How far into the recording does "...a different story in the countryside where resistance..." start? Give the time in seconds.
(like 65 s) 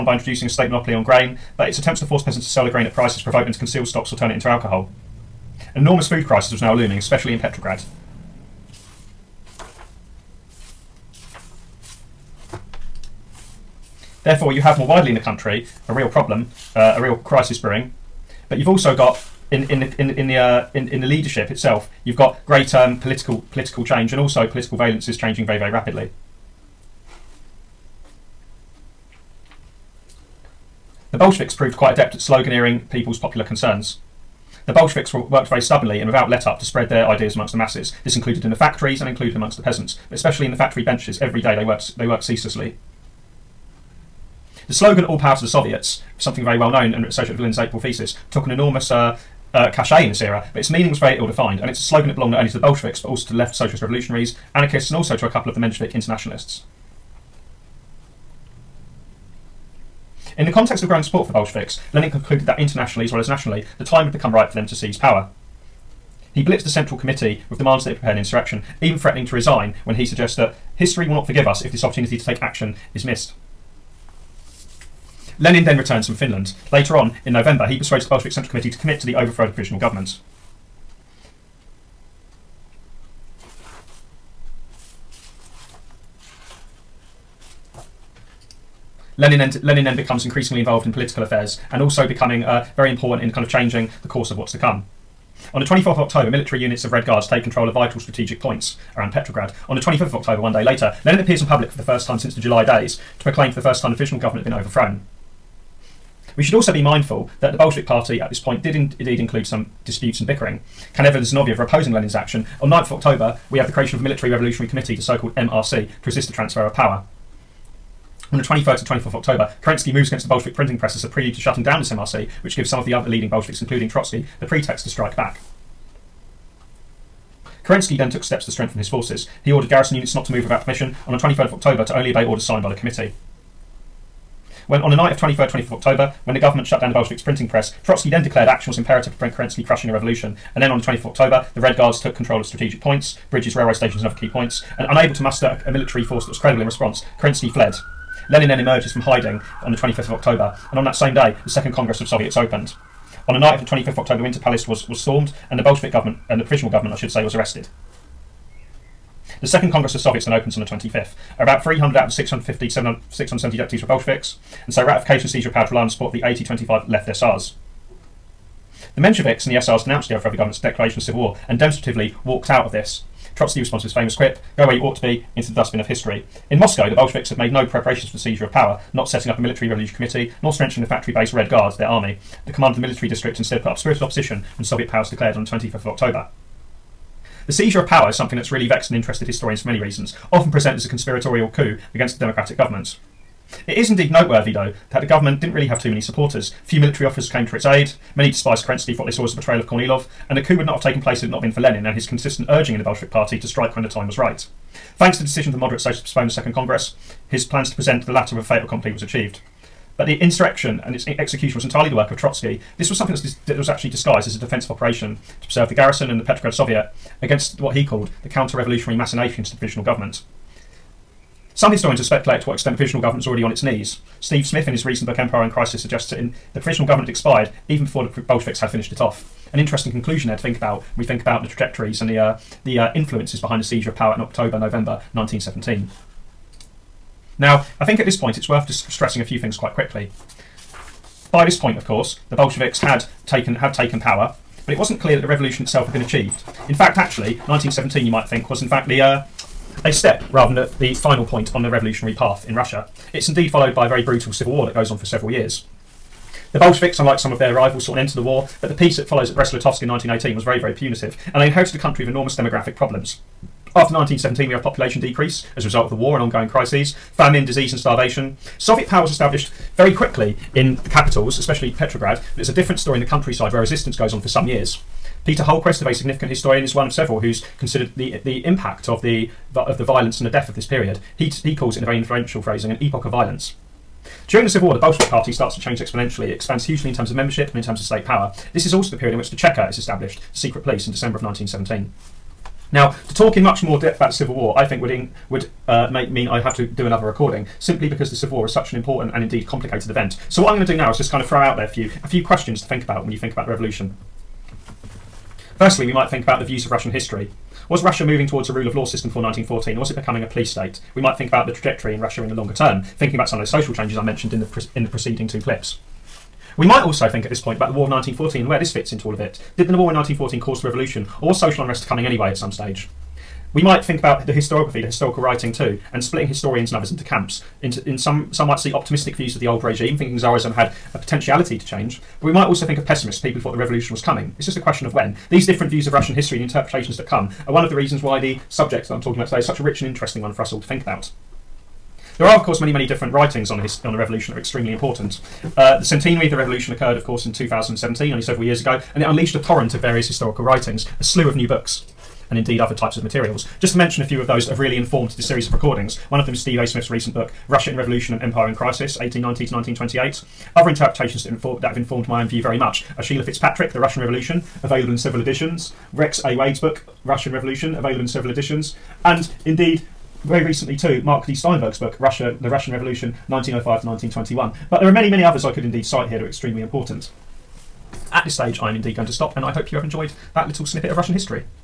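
272 s.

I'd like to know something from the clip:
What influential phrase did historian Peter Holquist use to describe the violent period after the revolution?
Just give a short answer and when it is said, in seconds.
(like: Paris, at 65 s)
an epoch of violence, at 282 s.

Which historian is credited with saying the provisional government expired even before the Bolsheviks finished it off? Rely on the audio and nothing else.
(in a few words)
Steve Smith.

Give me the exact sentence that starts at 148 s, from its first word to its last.
Lenin then emerges from hiding on the 25th of October, and on that same day, the Second Congress of Soviets opened.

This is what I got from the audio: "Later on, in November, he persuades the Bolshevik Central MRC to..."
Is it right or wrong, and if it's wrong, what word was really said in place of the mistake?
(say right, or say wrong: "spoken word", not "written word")
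wrong: "Committee", not "MRC".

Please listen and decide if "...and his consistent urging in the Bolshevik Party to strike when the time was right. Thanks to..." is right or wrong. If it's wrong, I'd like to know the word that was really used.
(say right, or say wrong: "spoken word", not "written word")
right.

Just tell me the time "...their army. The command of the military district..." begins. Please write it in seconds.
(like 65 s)
181 s.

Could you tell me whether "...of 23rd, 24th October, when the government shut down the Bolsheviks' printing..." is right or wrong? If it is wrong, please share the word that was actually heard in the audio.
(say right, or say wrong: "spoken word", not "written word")
right.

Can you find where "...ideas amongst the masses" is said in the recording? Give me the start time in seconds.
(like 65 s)
37 s.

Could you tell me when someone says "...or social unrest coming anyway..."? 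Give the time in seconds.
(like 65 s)
321 s.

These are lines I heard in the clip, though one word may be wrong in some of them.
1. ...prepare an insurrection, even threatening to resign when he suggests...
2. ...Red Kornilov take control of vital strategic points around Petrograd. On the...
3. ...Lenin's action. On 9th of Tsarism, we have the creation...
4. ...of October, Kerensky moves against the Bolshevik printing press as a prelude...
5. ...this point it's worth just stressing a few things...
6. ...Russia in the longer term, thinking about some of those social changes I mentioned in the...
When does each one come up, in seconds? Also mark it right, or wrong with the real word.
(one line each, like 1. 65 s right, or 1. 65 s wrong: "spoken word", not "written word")
1. 67 s right
2. 96 s wrong: "Guards", not "Kornilov"
3. 111 s wrong: "October", not "Tsarism"
4. 119 s right
5. 238 s right
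6. 311 s right.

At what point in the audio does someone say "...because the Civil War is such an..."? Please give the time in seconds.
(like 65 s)
297 s.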